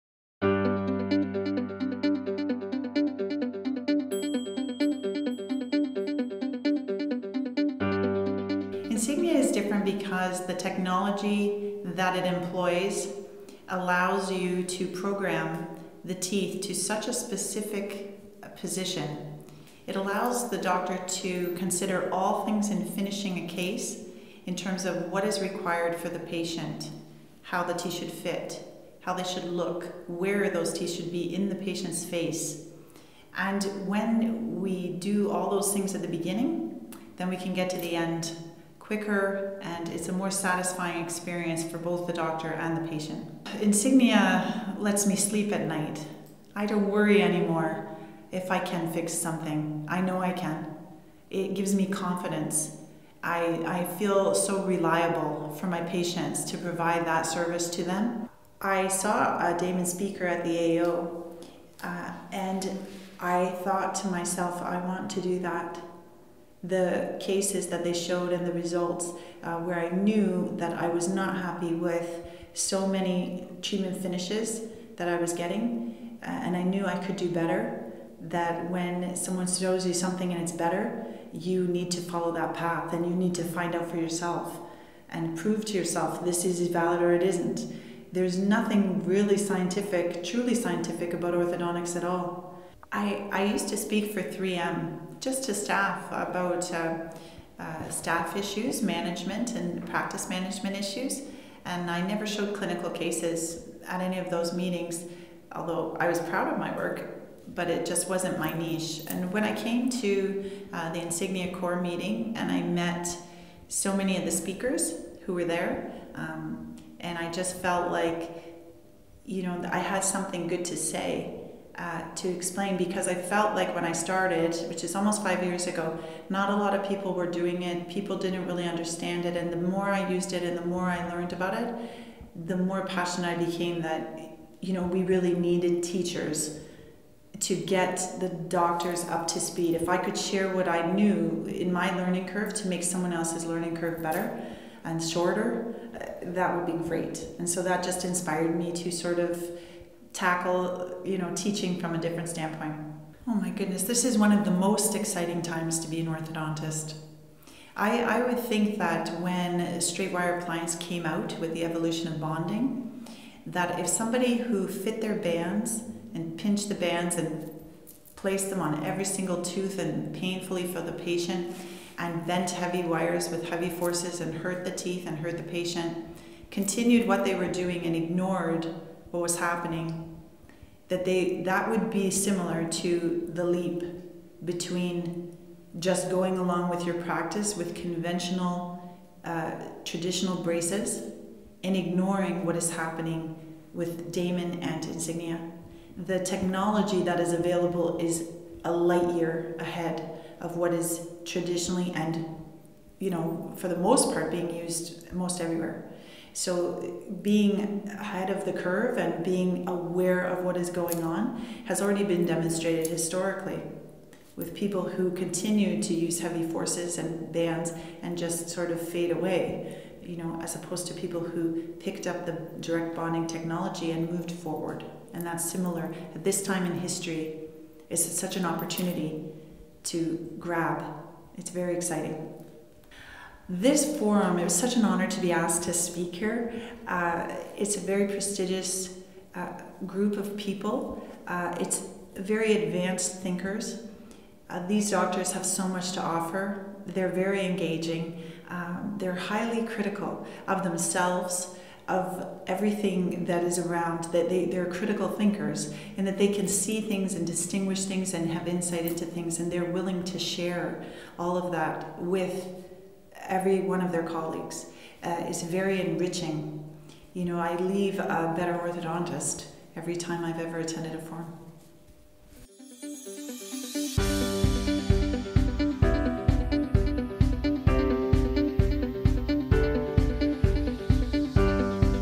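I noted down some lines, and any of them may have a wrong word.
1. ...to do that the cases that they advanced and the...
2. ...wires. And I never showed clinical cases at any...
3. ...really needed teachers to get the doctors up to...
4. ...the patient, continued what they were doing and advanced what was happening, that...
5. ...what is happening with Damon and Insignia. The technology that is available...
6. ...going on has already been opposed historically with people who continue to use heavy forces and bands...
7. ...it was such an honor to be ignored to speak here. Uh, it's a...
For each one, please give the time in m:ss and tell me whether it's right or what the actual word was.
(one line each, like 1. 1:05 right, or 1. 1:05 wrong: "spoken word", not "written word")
1. 1:05 wrong: "showed", not "advanced"
2. 1:40 wrong: "issues", not "wires"
3. 2:15 right
4. 2:55 wrong: "ignored", not "advanced"
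5. 3:12 right
6. 3:30 wrong: "demonstrated", not "opposed"
7. 3:54 wrong: "asked", not "ignored".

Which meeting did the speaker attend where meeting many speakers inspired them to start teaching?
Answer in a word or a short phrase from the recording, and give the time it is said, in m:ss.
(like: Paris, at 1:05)
Insignia Core meeting, at 1:51.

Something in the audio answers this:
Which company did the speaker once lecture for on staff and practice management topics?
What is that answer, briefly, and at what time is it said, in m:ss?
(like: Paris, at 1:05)
3M, at 1:34.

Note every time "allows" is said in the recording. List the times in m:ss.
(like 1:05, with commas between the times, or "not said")
0:13, 0:19.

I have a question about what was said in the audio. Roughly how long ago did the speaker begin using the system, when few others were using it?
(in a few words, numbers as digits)
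almost 5 years ago.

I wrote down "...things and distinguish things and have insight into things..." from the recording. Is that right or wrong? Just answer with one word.
right.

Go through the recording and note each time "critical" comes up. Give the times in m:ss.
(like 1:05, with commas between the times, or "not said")
4:09, 4:14.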